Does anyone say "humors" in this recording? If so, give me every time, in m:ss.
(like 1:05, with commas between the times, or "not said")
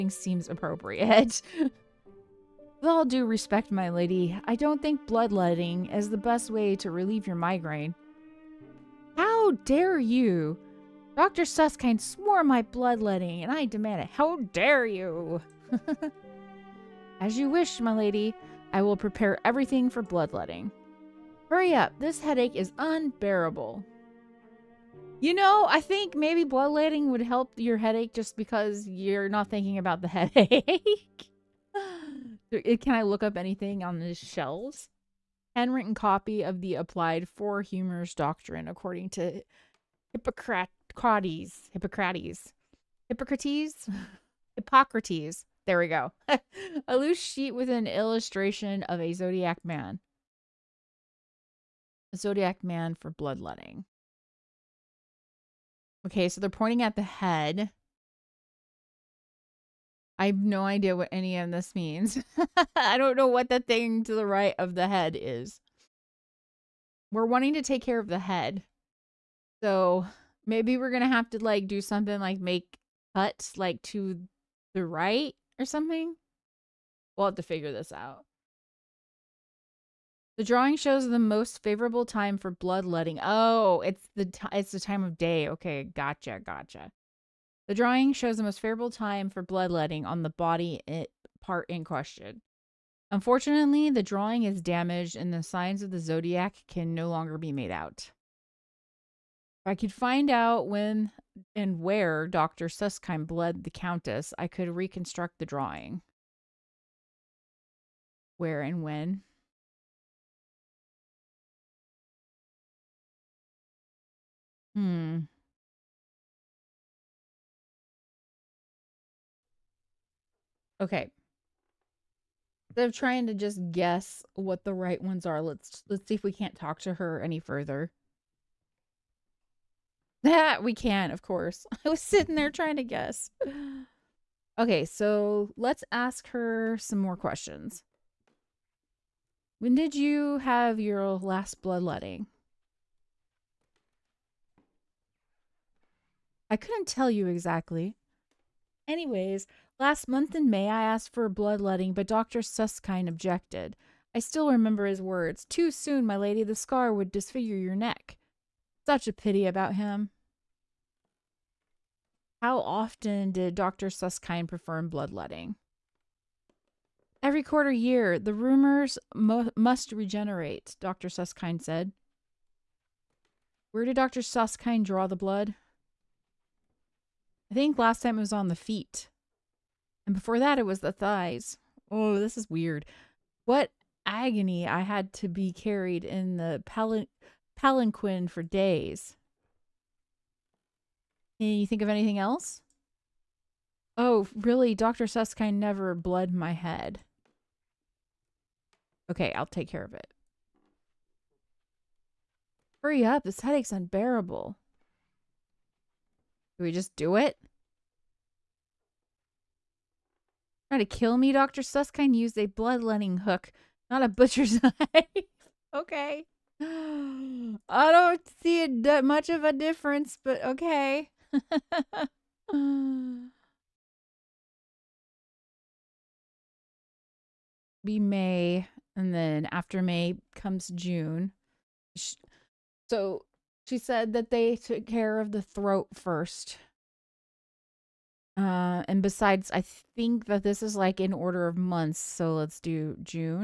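0:37.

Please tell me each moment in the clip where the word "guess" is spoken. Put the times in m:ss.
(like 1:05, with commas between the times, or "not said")
2:03, 2:12.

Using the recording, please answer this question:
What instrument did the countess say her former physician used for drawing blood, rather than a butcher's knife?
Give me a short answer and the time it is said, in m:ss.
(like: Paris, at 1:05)
bloodletting hook, at 3:32.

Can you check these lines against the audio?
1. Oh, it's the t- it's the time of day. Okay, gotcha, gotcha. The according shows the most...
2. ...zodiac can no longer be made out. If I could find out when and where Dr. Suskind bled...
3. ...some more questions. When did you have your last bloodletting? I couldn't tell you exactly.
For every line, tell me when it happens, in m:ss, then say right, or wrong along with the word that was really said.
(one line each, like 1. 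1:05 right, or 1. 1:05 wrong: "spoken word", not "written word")
1. 1:23 wrong: "drawing", not "according"
2. 1:35 right
3. 2:16 right.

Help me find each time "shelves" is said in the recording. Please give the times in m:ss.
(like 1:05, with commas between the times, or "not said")
0:34.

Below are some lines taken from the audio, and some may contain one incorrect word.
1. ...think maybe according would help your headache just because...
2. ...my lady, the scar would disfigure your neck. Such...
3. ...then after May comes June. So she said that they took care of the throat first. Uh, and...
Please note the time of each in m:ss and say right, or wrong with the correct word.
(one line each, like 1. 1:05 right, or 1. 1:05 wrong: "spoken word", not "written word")
1. 0:25 wrong: "bloodletting", not "according"
2. 2:36 right
3. 3:49 right.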